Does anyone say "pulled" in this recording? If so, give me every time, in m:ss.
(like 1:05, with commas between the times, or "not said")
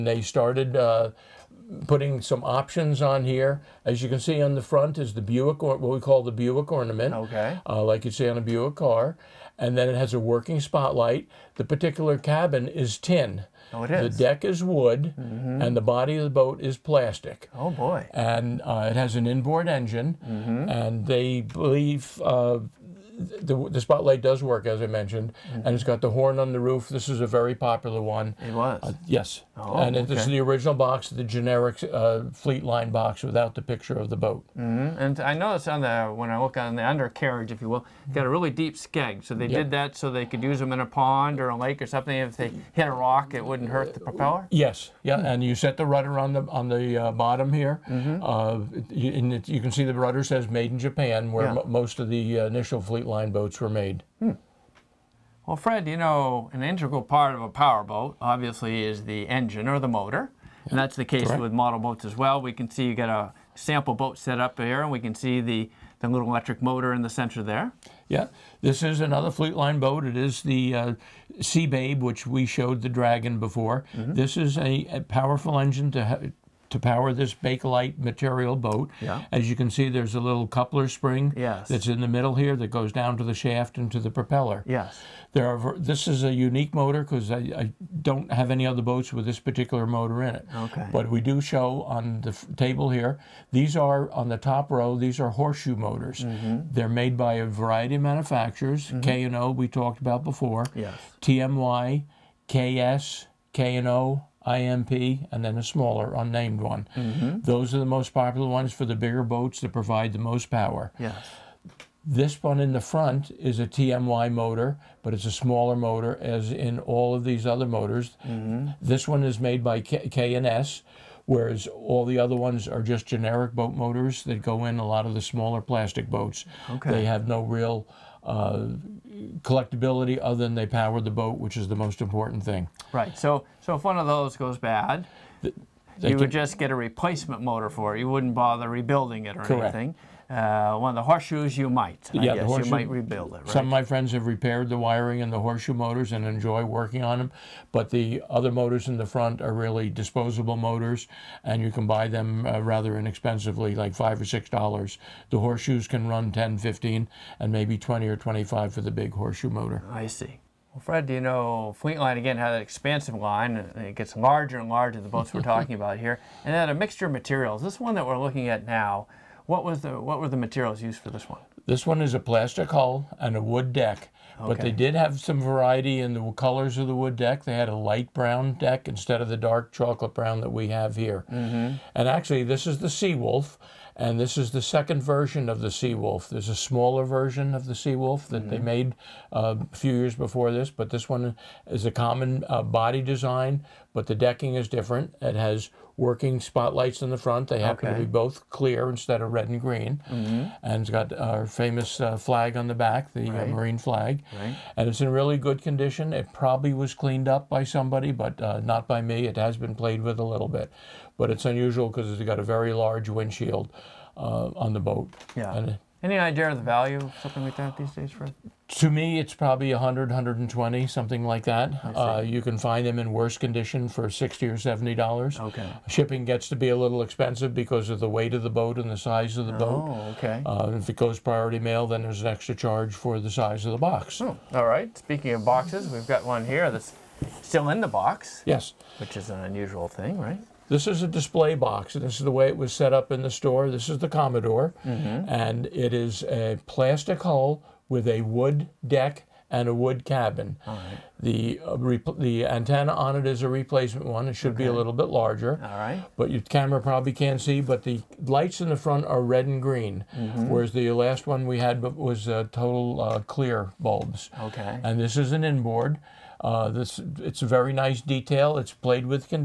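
not said.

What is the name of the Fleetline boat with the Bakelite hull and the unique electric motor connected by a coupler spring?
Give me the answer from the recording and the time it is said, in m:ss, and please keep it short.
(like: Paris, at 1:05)
Sea Babe, at 1:11.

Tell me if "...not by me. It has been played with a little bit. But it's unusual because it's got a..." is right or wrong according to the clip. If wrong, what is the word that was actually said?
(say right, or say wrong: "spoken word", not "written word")
right.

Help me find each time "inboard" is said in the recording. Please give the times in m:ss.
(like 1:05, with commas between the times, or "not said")
0:19, 4:25.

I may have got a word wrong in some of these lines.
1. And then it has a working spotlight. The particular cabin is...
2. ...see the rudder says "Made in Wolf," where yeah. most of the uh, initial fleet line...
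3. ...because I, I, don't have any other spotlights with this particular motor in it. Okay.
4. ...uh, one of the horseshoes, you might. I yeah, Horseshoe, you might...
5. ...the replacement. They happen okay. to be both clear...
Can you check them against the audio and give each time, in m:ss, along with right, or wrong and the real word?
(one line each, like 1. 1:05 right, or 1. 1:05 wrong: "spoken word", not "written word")
1. 0:09 right
2. 0:49 wrong: "Japan", not "Wolf"
3. 1:27 wrong: "boats", not "spotlights"
4. 2:20 right
5. 3:17 wrong: "front", not "replacement".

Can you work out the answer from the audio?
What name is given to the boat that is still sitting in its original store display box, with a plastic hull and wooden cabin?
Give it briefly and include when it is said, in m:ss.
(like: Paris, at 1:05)
Commodore, at 4:03.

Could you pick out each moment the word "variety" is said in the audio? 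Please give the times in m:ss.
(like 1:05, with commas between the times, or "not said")
1:37, 2:55.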